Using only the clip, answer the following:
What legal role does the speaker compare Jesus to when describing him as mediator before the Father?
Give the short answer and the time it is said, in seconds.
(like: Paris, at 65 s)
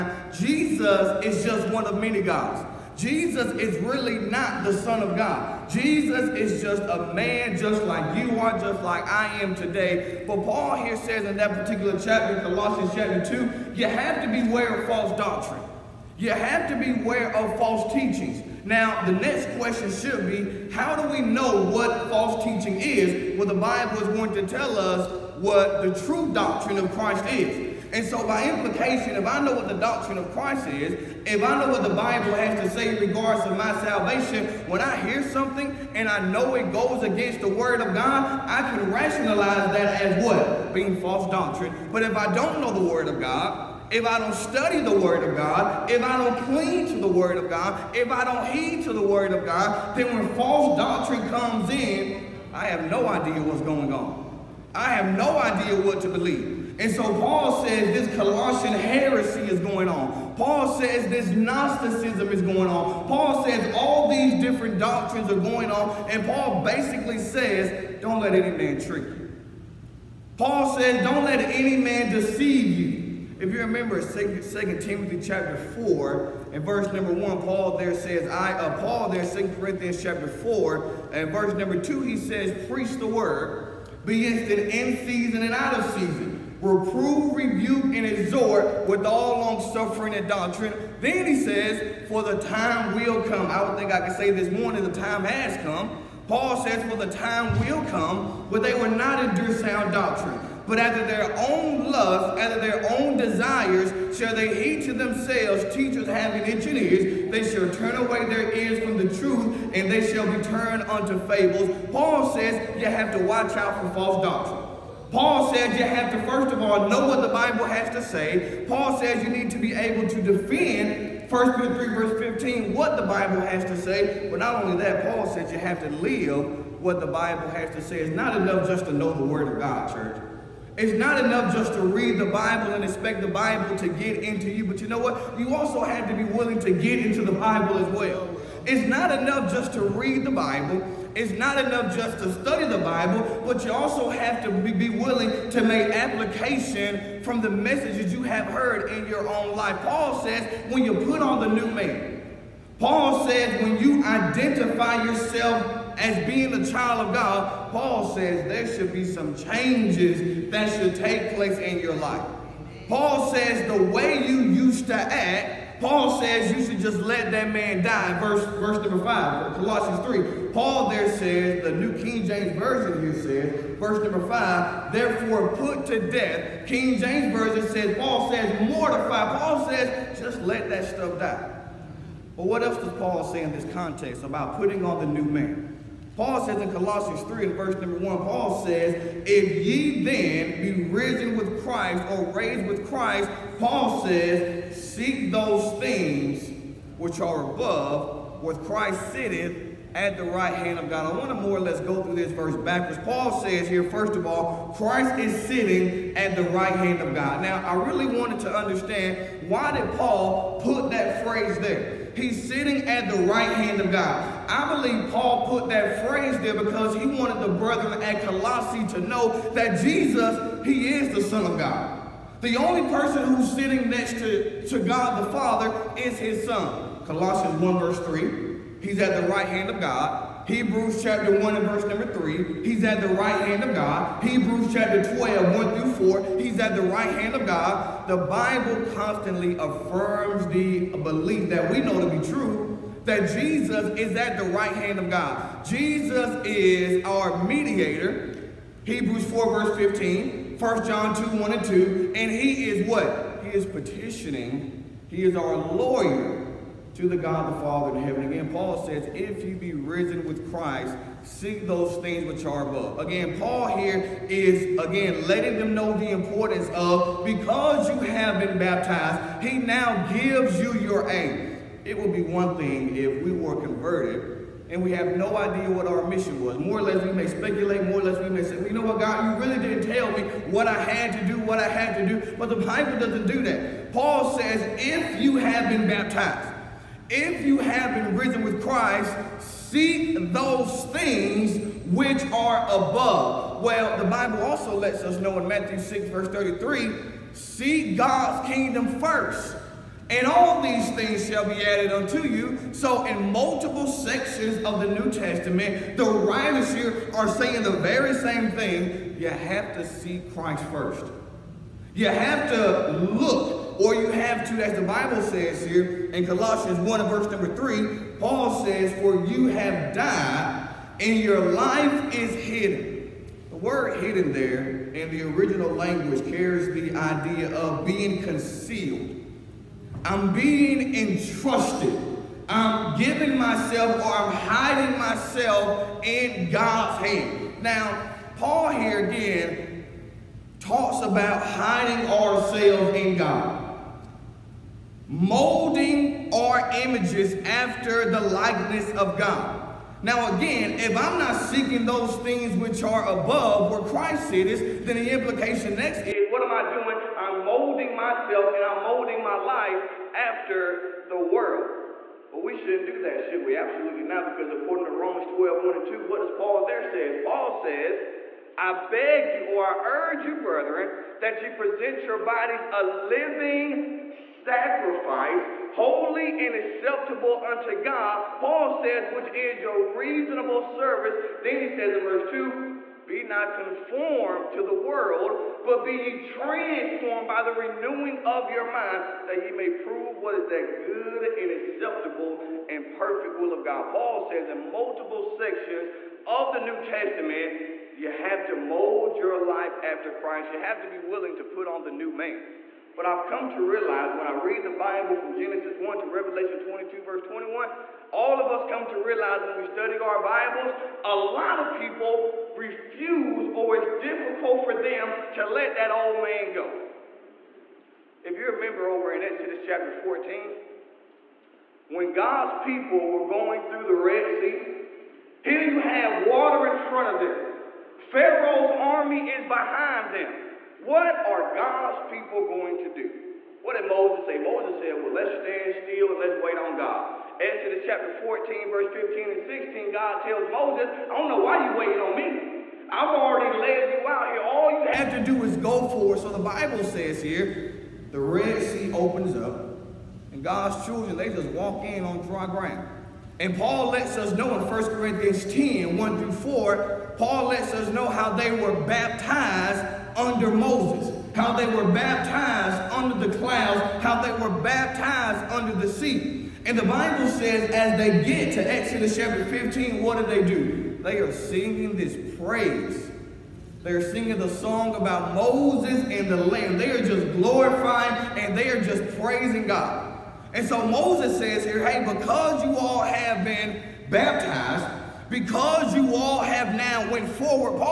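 Lawyer, at 255 s.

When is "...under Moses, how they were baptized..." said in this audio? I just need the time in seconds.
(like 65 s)
460 s.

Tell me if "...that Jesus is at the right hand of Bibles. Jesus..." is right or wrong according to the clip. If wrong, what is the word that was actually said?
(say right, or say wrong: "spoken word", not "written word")
wrong: "God", not "Bibles".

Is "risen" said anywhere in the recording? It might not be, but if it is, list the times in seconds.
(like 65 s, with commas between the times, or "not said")
190 s, 259 s, 288 s.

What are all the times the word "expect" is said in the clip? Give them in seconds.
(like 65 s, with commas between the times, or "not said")
132 s.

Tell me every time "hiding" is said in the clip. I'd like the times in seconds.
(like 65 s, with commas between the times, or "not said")
334 s, 341 s.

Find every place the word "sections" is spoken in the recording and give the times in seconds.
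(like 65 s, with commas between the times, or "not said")
303 s, 395 s.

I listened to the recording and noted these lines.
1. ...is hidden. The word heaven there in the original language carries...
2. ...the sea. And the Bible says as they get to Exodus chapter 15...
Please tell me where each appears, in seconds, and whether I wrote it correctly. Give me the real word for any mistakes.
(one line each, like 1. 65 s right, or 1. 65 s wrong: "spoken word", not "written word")
1. 322 s wrong: "hidden", not "heaven"
2. 465 s right.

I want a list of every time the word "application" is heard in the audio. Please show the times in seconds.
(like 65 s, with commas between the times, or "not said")
145 s.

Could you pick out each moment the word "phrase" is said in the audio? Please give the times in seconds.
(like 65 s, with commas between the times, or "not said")
211 s, 216 s.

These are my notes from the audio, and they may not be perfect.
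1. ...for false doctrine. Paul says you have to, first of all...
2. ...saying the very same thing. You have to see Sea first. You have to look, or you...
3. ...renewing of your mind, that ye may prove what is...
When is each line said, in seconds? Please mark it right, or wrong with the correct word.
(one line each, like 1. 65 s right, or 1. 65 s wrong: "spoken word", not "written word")
1. 113 s right
2. 307 s wrong: "Christ", not "Sea"
3. 387 s right.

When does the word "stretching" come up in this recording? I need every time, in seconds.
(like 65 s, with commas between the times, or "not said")
not said.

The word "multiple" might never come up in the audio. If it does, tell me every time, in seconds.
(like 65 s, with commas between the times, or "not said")
303 s, 394 s.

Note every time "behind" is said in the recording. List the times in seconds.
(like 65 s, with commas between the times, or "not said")
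429 s.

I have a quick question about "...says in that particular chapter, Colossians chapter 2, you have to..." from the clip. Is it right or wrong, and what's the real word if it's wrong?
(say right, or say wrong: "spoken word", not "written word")
right.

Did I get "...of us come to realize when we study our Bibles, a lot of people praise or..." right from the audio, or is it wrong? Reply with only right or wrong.
wrong.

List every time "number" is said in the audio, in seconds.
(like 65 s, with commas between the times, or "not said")
76 s, 81 s, 168 s, 174 s, 187 s, 231 s, 317 s.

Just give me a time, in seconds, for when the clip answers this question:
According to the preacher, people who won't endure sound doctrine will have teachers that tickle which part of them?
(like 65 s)
106 s.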